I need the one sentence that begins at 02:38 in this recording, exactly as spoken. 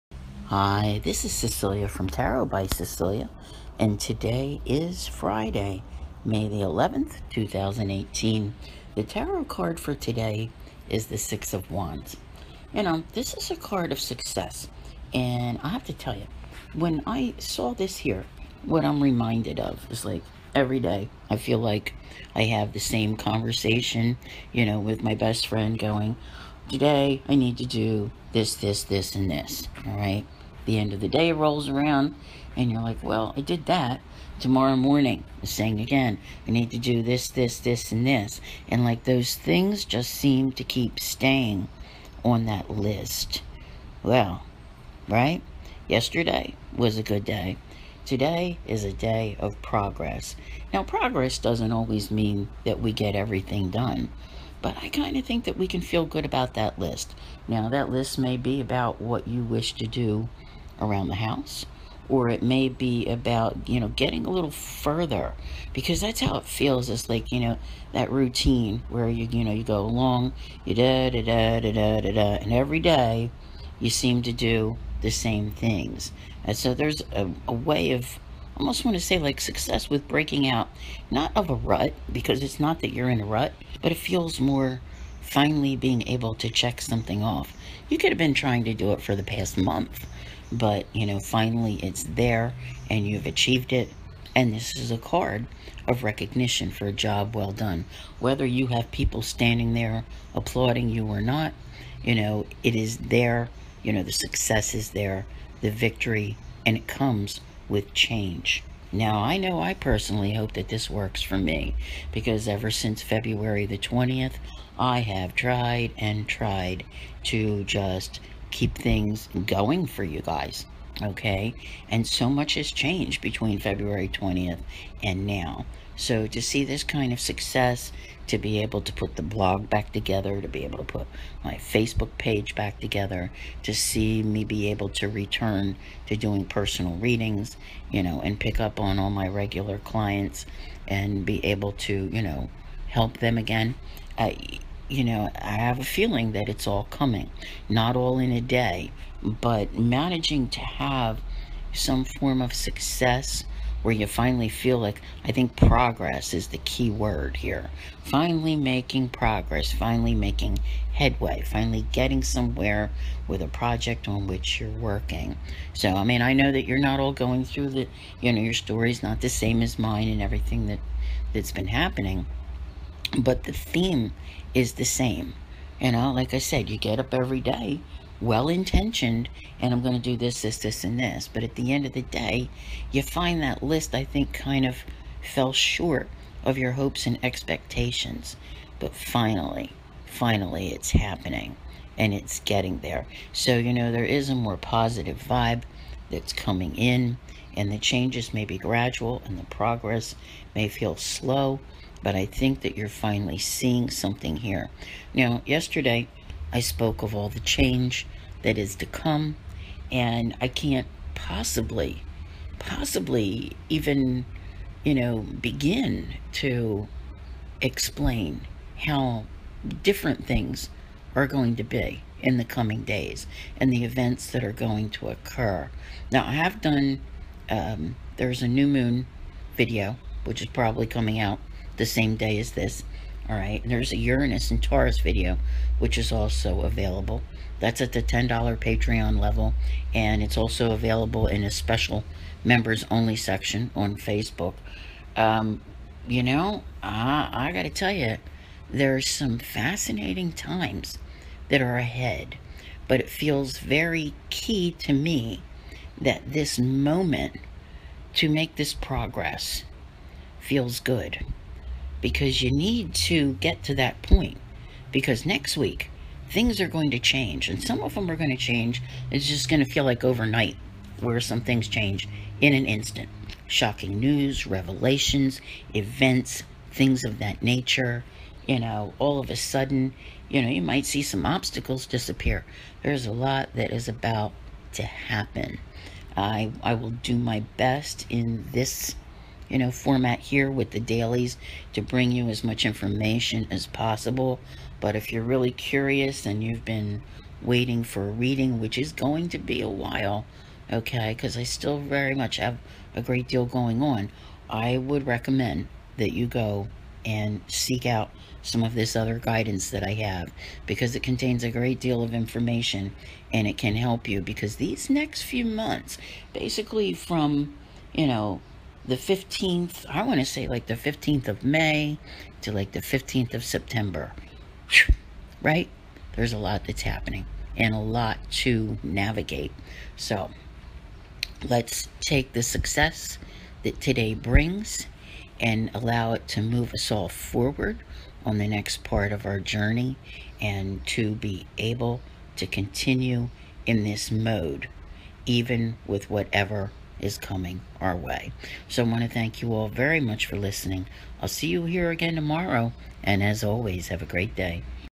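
Finally making progress, finally making headway, finally getting somewhere with a project on which you're working.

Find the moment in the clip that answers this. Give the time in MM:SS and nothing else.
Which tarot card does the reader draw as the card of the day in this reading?
00:11.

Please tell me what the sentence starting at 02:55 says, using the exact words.
You know, like I said, you get up every day well intentioned and I'm going to do this, this, this, and this.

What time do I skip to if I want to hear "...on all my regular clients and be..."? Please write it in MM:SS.
02:18.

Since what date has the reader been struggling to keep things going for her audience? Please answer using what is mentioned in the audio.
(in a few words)
February 20th.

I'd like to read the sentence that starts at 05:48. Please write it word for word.
So I want to thank you all very much for listening.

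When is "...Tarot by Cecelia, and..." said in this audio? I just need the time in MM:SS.
00:02.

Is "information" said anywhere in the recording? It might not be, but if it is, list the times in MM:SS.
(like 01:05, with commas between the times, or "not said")
04:52, 05:12.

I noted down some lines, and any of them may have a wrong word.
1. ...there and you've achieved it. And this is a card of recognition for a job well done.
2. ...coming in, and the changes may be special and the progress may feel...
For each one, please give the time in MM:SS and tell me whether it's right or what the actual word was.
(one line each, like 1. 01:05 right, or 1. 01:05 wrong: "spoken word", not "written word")
1. 01:32 right
2. 03:16 wrong: "gradual", not "special".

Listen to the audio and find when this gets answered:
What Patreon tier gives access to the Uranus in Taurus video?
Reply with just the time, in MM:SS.
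03:58.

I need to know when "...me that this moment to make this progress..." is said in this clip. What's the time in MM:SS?
04:14.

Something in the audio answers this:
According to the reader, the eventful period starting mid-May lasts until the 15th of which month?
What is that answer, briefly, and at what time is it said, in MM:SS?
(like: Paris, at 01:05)
September, at 05:23.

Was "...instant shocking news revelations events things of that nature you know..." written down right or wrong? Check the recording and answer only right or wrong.
right.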